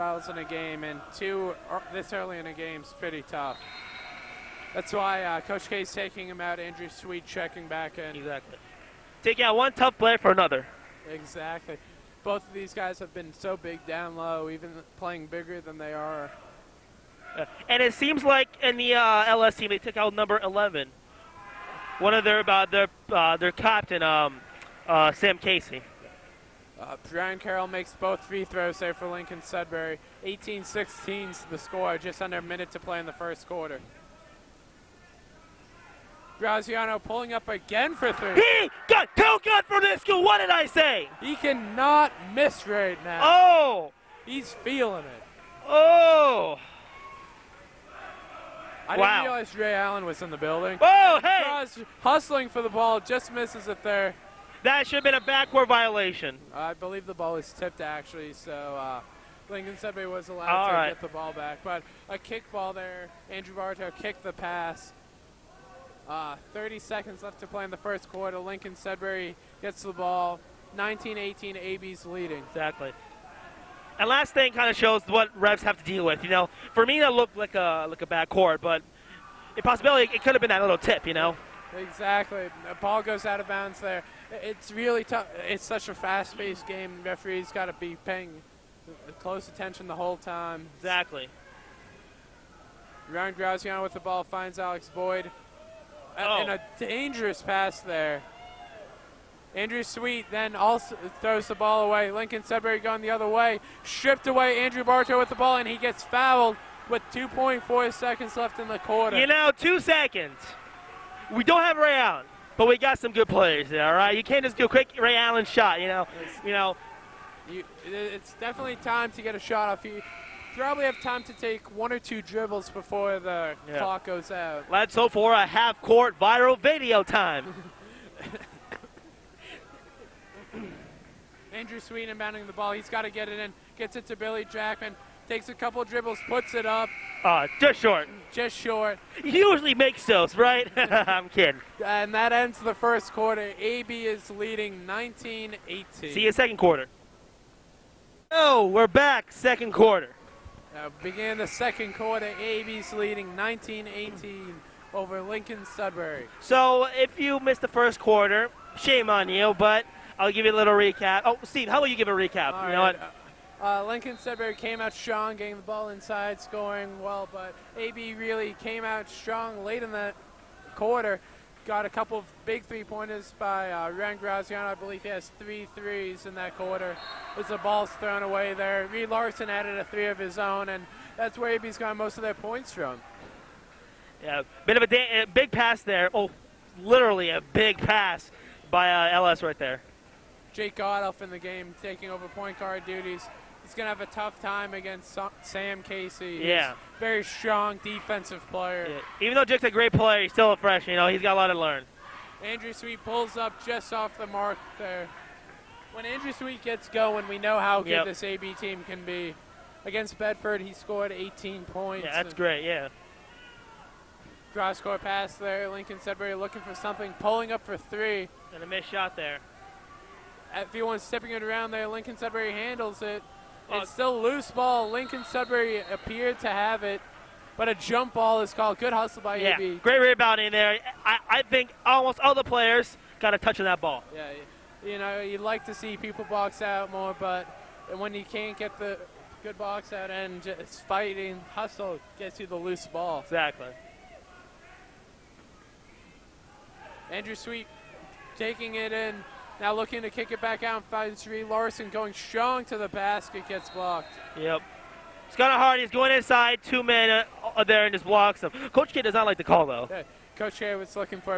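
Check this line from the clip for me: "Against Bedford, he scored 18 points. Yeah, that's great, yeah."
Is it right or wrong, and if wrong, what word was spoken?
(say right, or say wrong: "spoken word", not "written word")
right.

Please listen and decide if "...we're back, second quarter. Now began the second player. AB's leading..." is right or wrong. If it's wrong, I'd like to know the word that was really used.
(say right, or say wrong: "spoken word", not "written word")
wrong: "quarter", not "player".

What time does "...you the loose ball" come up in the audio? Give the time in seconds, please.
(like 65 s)
242 s.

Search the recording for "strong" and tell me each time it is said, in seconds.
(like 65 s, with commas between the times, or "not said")
164 s, 169 s, 197 s, 252 s.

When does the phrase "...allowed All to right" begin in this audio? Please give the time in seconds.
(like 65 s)
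60 s.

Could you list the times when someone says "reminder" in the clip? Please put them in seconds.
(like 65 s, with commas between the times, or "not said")
not said.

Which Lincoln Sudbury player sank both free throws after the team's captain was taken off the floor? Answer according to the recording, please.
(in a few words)
Brian Carroll.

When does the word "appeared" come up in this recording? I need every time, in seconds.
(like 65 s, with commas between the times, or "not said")
225 s.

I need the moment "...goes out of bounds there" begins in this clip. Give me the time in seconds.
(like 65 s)
83 s.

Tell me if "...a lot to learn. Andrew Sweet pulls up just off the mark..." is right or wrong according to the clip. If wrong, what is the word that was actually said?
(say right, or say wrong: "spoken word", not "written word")
right.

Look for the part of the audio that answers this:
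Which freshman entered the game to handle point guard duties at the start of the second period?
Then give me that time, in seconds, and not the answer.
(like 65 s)
190 s.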